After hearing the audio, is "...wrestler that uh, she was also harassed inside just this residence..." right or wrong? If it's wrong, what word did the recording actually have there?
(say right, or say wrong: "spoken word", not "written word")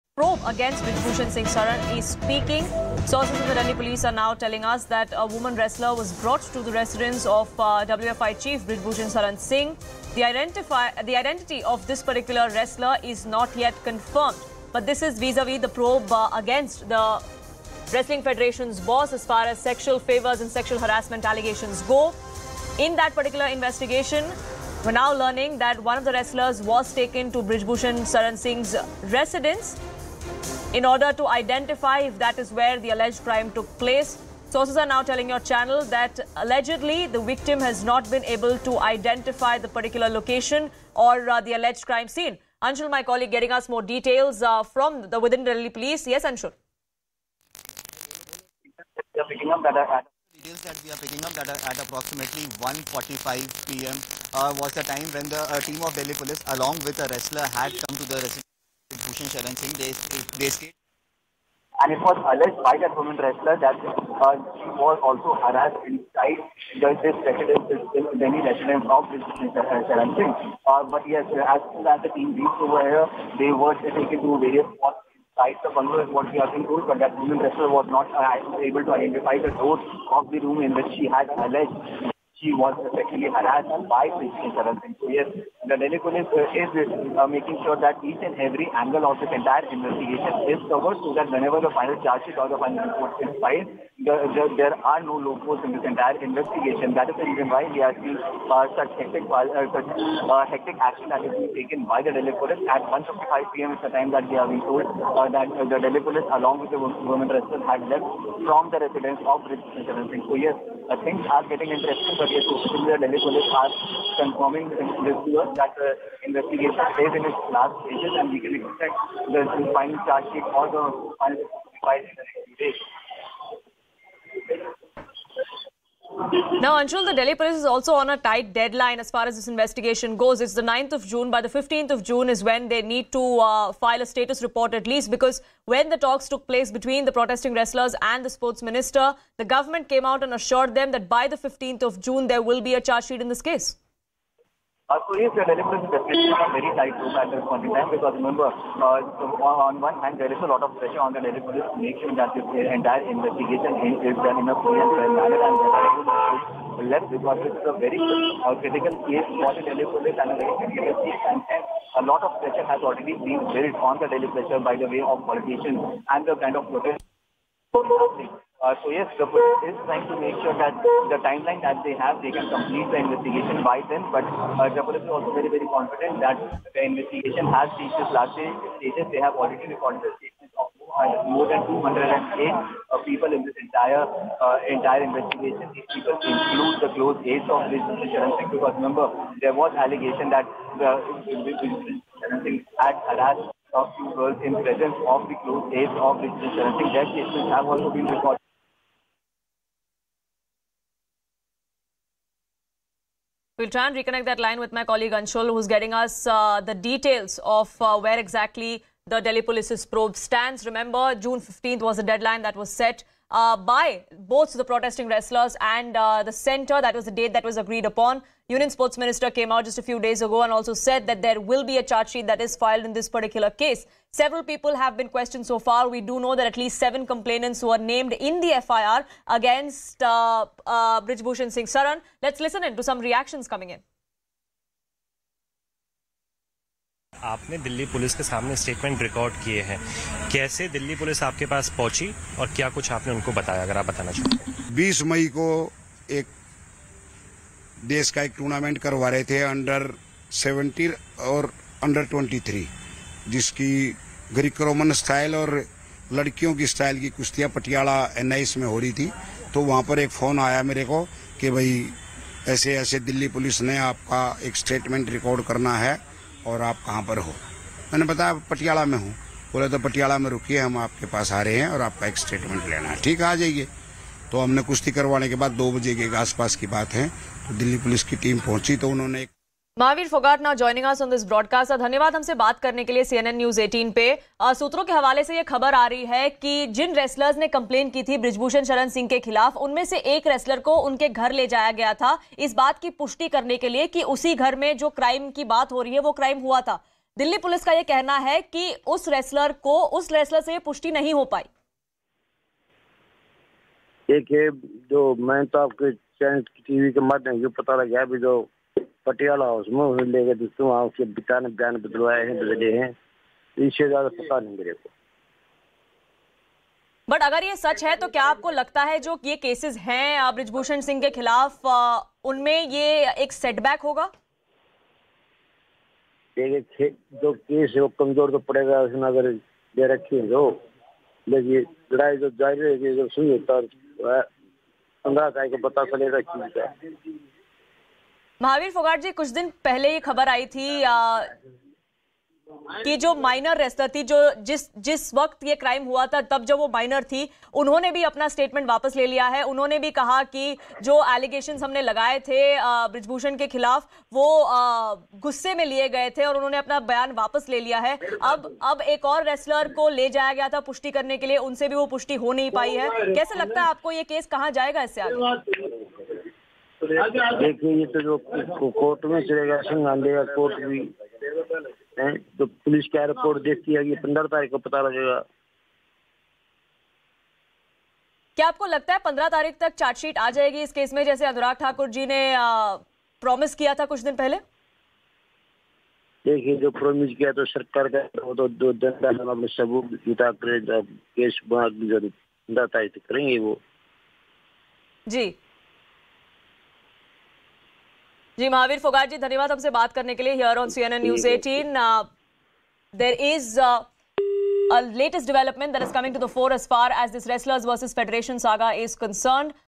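right.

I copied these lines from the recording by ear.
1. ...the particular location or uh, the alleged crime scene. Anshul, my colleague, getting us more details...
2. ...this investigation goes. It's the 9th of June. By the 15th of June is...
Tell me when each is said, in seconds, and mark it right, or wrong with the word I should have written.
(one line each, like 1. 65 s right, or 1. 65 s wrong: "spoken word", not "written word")
1. 39 s right
2. 129 s right.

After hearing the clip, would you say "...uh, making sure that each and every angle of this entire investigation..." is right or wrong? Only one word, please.
right.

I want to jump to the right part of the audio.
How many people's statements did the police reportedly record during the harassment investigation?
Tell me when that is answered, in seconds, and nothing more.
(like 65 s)
181 s.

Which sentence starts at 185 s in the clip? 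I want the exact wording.
These people include the close aides of this Singh.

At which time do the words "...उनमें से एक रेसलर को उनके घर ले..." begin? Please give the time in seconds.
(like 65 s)
289 s.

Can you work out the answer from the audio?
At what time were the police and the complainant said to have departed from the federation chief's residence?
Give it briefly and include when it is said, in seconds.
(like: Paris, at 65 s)
1:55 p.m., at 102 s.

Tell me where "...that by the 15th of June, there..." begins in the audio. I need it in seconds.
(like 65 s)
140 s.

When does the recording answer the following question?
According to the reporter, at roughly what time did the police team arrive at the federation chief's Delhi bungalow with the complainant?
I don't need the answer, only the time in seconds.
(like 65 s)
52 s.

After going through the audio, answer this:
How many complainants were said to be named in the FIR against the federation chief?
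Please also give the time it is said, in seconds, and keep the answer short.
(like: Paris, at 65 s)
7, at 226 s.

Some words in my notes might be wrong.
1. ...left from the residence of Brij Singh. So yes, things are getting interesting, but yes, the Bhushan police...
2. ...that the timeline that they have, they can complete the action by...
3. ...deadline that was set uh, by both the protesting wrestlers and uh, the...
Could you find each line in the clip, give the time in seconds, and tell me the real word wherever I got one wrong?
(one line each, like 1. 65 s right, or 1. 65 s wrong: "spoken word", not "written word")
1. 107 s wrong: "Delhi", not "Bhushan"
2. 170 s wrong: "investigation", not "action"
3. 212 s right.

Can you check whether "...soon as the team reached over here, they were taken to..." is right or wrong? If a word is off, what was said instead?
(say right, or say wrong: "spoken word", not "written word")
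right.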